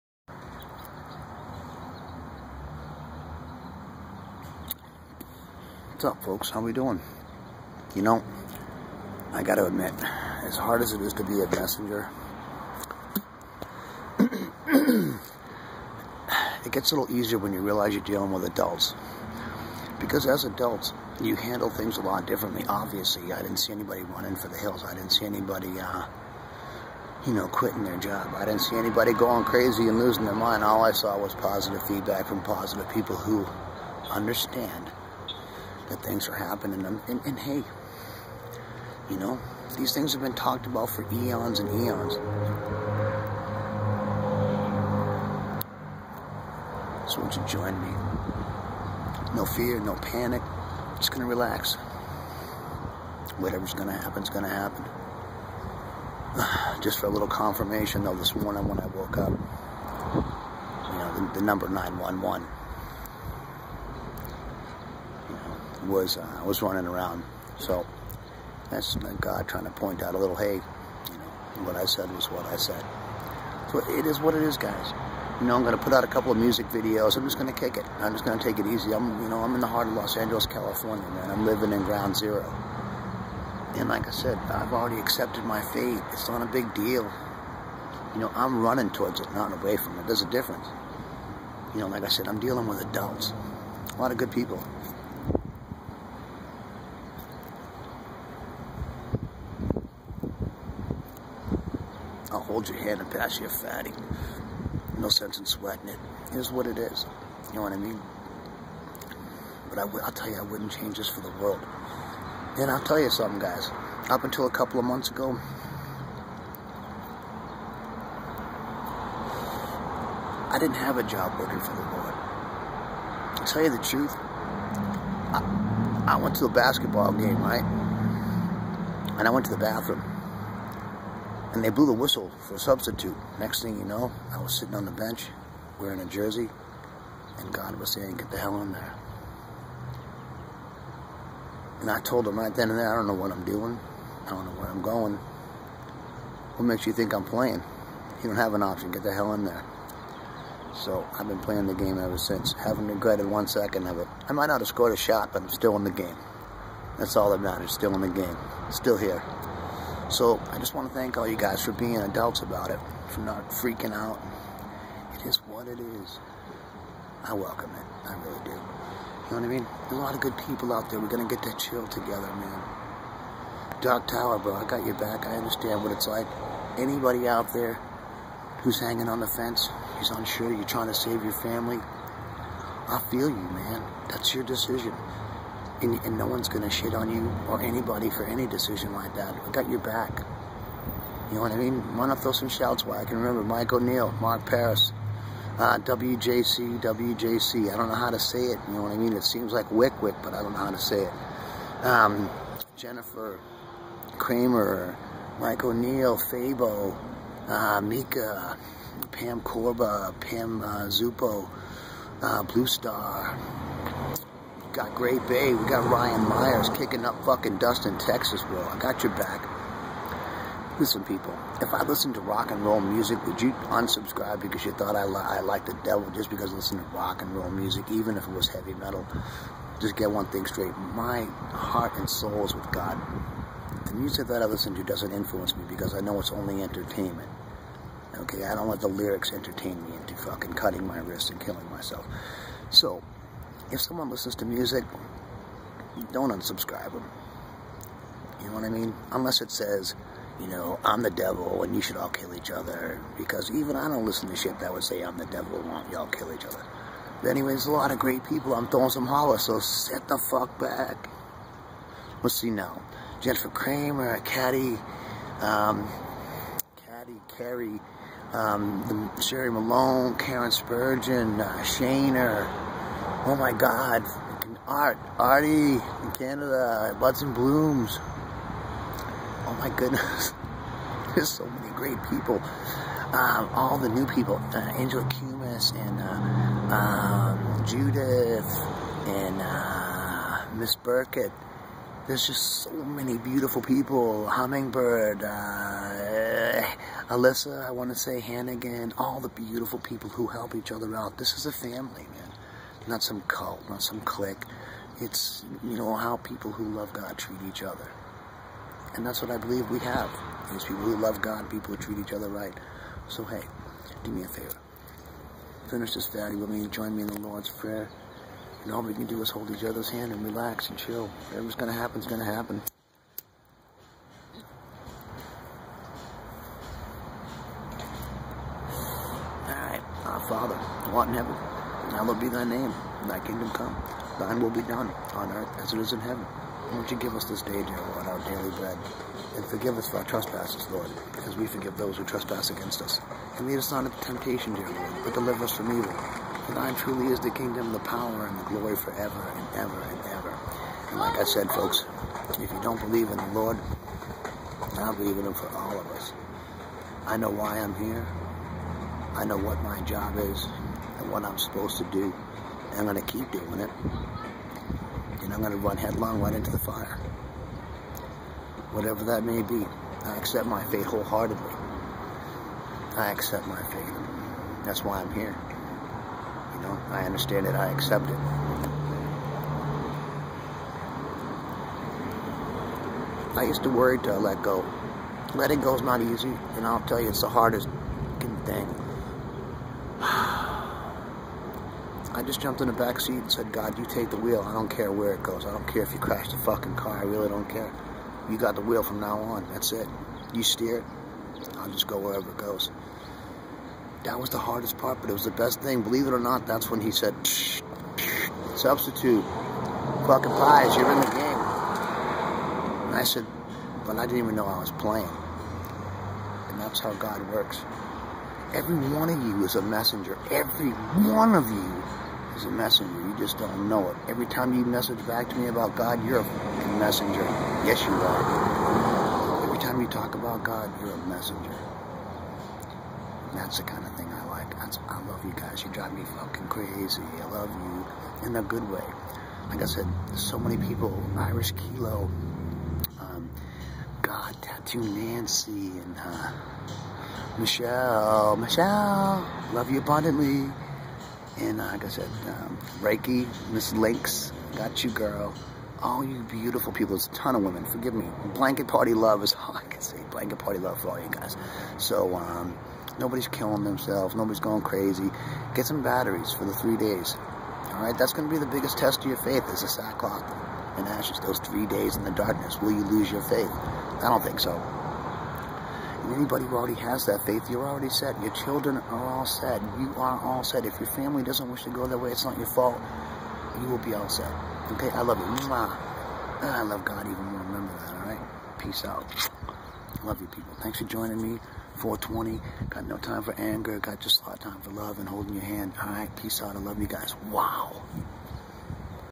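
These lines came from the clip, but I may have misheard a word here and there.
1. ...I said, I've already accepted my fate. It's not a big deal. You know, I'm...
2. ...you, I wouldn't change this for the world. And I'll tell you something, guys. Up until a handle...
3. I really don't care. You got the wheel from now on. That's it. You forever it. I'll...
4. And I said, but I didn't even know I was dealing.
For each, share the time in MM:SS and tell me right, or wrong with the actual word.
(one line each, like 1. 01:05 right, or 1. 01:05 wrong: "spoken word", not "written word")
1. 01:24 right
2. 01:50 wrong: "couple", not "handle"
3. 06:36 wrong: "steer", not "forever"
4. 06:52 wrong: "playing", not "dealing".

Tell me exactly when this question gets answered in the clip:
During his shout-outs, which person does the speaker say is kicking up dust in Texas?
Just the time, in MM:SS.
03:35.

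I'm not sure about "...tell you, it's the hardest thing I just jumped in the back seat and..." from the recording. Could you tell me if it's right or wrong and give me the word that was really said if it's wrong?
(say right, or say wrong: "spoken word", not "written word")
right.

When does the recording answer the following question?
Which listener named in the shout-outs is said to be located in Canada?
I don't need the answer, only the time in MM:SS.
04:35.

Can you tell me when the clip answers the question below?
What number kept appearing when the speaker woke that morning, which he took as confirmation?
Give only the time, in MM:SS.
01:01.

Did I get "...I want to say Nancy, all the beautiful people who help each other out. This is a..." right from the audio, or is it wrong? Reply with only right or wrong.
wrong.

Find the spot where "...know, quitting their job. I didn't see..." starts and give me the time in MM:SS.
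00:27.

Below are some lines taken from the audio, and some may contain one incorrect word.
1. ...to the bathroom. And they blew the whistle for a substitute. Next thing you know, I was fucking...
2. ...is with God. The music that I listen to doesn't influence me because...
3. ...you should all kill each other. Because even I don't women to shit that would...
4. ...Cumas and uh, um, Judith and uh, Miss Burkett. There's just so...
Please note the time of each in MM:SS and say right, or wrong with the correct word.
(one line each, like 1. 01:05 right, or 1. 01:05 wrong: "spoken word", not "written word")
1. 02:09 wrong: "sitting", not "fucking"
2. 03:52 right
3. 04:11 wrong: "listen", not "women"
4. 04:45 right.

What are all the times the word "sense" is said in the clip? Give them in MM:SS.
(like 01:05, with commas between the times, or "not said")
01:45.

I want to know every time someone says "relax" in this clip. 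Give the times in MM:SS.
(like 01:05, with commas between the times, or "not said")
00:51, 05:20.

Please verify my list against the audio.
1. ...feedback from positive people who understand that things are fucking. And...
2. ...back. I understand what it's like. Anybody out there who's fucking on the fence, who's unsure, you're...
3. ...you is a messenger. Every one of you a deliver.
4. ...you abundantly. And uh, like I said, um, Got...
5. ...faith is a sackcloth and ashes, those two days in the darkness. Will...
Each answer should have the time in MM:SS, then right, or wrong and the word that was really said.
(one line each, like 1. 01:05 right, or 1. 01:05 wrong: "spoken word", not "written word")
1. 00:31 wrong: "happening", not "fucking"
2. 02:54 wrong: "hanging", not "fucking"
3. 06:59 wrong: "messenger", not "deliver"
4. 07:29 wrong: "Reiki", not "Got"
5. 07:49 wrong: "three", not "two".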